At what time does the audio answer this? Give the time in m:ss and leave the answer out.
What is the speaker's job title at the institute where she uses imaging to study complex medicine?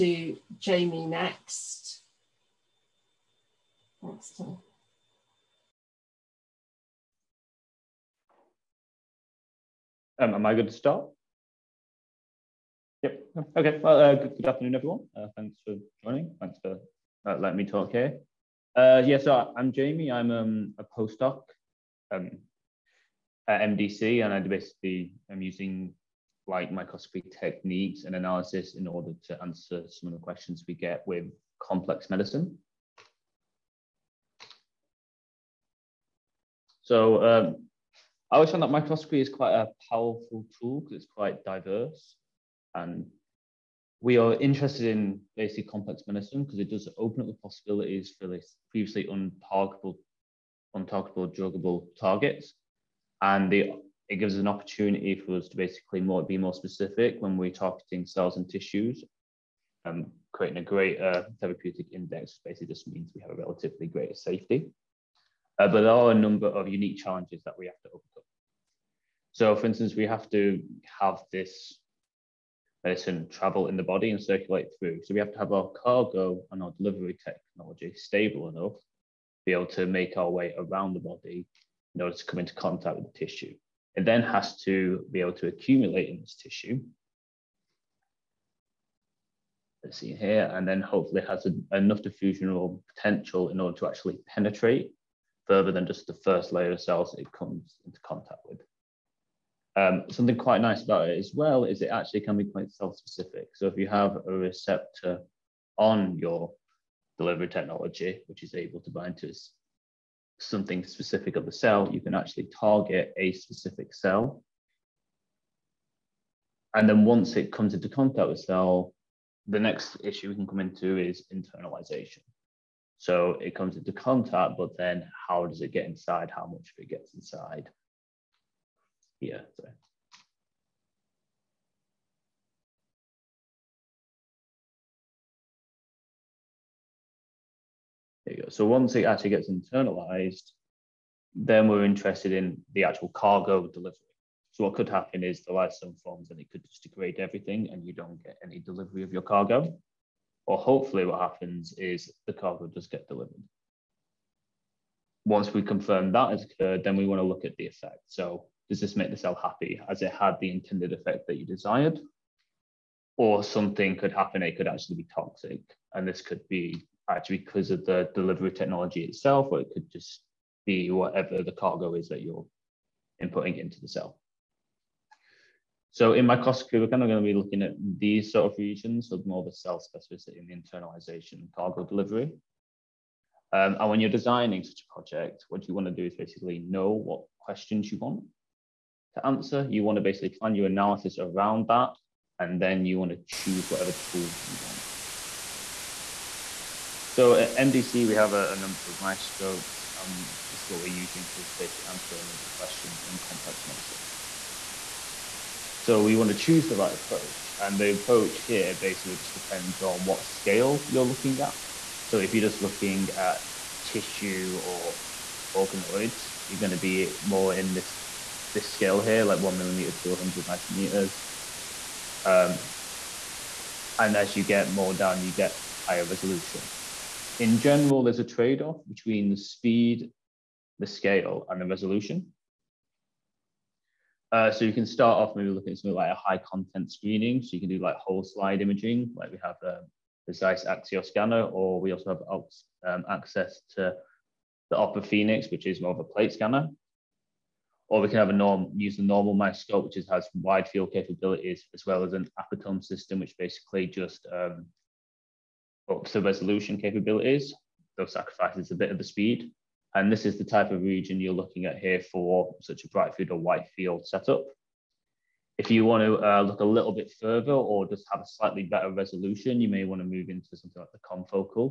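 0:20.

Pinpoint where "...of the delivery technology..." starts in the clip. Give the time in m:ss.
2:47.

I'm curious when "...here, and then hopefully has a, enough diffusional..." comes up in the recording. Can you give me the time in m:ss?
1:30.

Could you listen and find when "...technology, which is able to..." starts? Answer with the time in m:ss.
1:47.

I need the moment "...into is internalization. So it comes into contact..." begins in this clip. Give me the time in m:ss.
2:00.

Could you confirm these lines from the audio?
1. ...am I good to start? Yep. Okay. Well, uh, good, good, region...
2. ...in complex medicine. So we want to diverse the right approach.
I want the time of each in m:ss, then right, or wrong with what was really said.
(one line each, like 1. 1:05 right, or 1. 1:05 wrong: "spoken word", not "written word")
1. 0:10 wrong: "afternoon", not "region"
2. 3:23 wrong: "choose", not "diverse".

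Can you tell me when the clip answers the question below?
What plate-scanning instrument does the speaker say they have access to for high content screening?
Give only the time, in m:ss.
4:04.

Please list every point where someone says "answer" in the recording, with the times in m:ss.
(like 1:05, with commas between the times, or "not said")
0:29, 3:09, 3:21.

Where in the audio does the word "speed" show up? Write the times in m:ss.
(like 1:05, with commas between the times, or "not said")
3:49, 4:19.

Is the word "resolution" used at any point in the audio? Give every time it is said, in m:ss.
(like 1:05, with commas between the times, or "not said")
3:46, 3:51, 4:16, 4:28.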